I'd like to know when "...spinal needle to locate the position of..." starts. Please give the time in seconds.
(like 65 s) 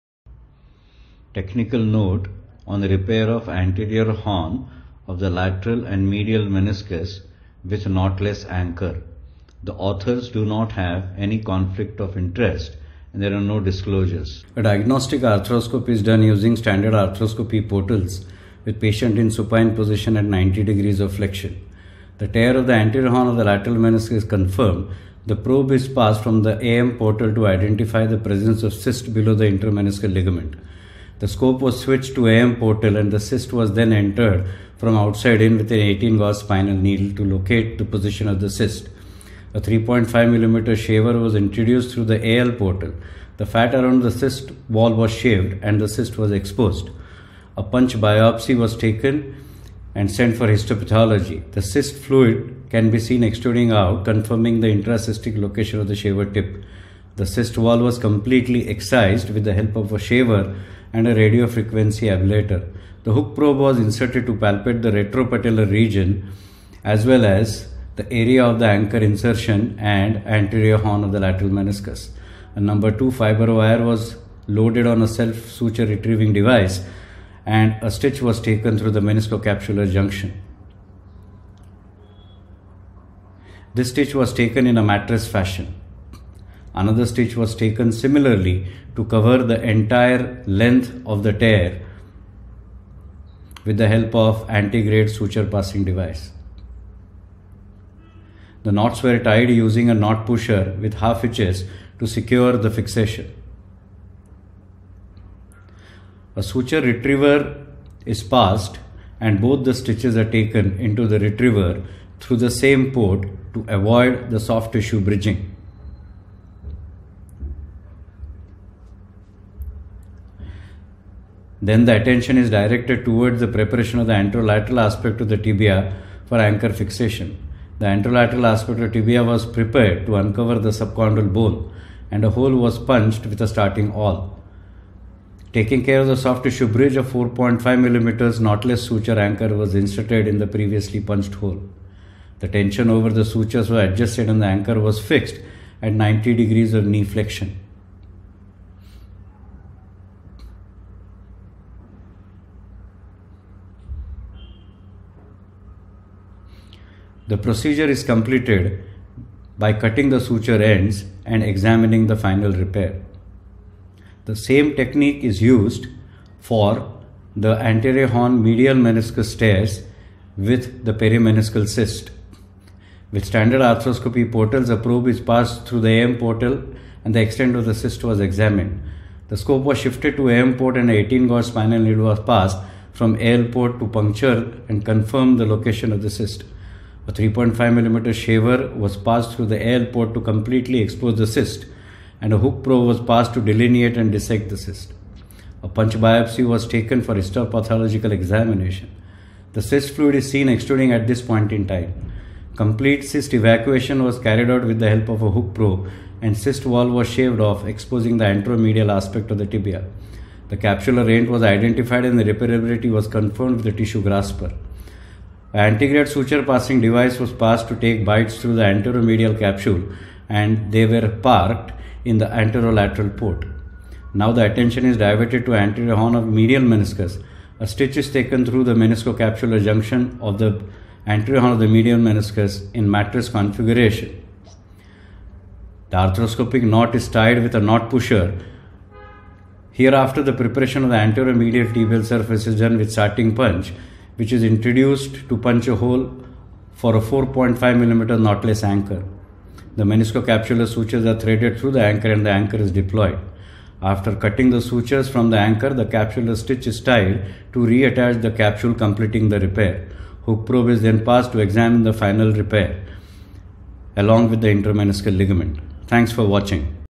36 s.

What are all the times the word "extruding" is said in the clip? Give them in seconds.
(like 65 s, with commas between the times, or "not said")
53 s, 200 s.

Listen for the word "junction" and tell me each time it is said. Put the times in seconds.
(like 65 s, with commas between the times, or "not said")
79 s, 229 s.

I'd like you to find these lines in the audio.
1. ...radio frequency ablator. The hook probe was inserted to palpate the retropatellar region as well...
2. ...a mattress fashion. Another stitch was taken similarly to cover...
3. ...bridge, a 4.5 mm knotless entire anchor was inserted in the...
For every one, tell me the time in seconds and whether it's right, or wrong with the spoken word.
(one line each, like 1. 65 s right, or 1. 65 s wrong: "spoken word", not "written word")
1. 61 s right
2. 84 s right
3. 136 s wrong: "suture", not "entire".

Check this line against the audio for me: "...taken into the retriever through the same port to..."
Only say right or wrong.
right.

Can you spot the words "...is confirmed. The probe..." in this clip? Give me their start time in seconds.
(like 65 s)
24 s.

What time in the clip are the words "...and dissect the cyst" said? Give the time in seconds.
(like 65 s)
193 s.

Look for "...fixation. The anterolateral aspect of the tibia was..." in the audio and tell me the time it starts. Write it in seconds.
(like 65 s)
126 s.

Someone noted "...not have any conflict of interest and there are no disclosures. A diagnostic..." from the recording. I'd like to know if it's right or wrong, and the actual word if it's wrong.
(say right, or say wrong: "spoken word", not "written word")
right.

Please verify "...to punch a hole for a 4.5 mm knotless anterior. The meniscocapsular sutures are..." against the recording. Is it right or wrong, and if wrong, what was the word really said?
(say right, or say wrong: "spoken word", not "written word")
wrong: "anchor", not "anterior".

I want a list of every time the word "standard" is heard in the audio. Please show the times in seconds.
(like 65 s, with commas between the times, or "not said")
16 s, 173 s.